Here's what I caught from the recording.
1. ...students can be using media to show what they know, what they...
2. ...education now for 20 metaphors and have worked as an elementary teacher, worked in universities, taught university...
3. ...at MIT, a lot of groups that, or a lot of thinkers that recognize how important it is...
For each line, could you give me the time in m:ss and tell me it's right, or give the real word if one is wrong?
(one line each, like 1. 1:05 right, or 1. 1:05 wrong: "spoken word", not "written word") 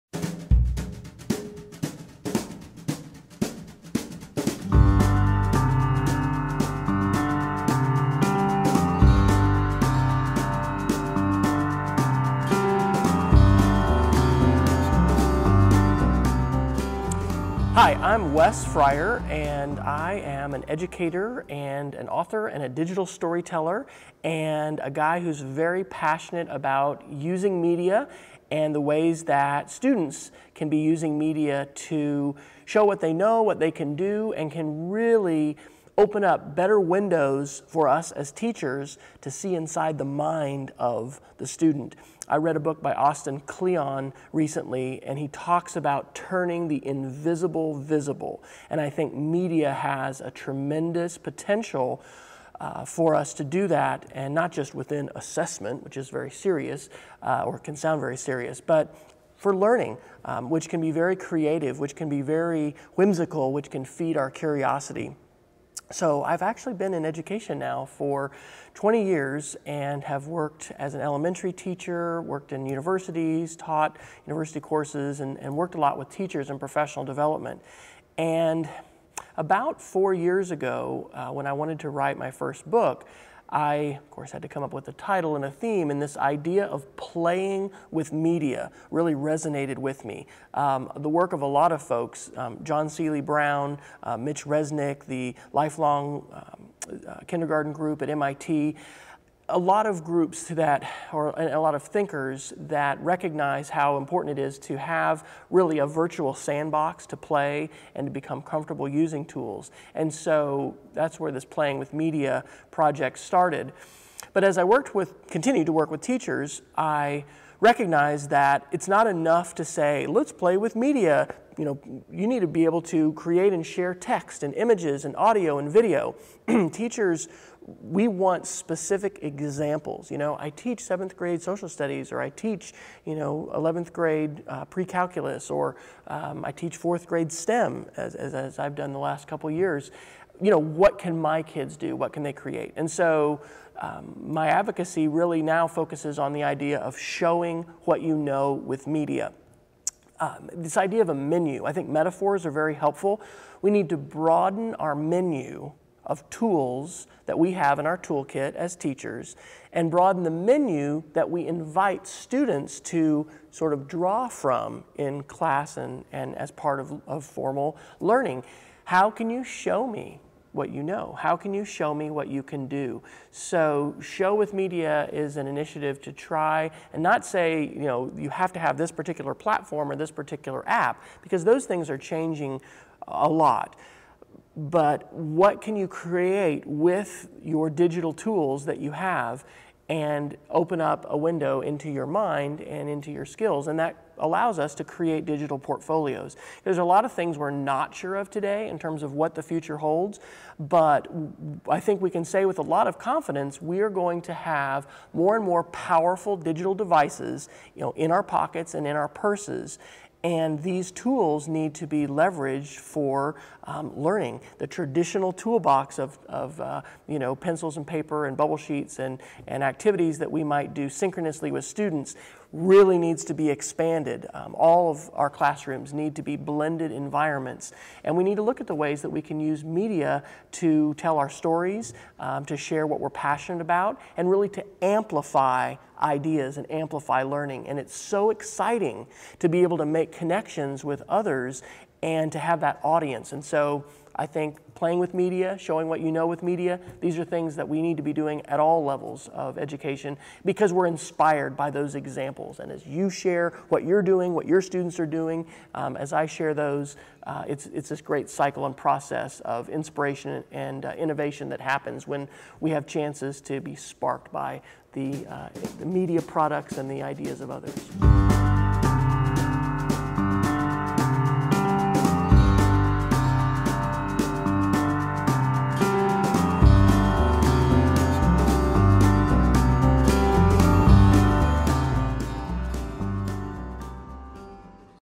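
1. 0:29 right
2. 1:07 wrong: "years", not "metaphors"
3. 1:38 right.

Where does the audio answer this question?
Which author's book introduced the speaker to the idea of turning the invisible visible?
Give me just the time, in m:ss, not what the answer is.
0:42.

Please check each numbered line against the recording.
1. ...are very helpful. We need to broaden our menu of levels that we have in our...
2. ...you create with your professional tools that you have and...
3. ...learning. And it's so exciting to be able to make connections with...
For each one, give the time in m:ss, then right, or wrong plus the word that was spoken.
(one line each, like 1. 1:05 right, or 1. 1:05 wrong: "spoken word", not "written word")
1. 2:32 wrong: "tools", not "levels"
2. 3:05 wrong: "digital", not "professional"
3. 3:57 right.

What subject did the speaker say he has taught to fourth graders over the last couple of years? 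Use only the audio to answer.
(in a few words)
STEM.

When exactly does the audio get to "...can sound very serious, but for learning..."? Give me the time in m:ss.
0:57.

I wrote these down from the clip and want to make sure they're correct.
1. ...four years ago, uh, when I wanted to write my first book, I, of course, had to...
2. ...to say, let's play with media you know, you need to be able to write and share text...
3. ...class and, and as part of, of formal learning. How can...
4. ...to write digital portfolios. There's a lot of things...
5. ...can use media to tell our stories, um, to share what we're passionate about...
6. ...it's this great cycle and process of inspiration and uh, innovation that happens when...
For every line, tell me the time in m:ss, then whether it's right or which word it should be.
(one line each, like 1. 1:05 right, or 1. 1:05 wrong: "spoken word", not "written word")
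1. 1:19 right
2. 1:59 wrong: "create", not "write"
3. 2:45 right
4. 3:14 wrong: "create", not "write"
5. 3:49 right
6. 4:17 right.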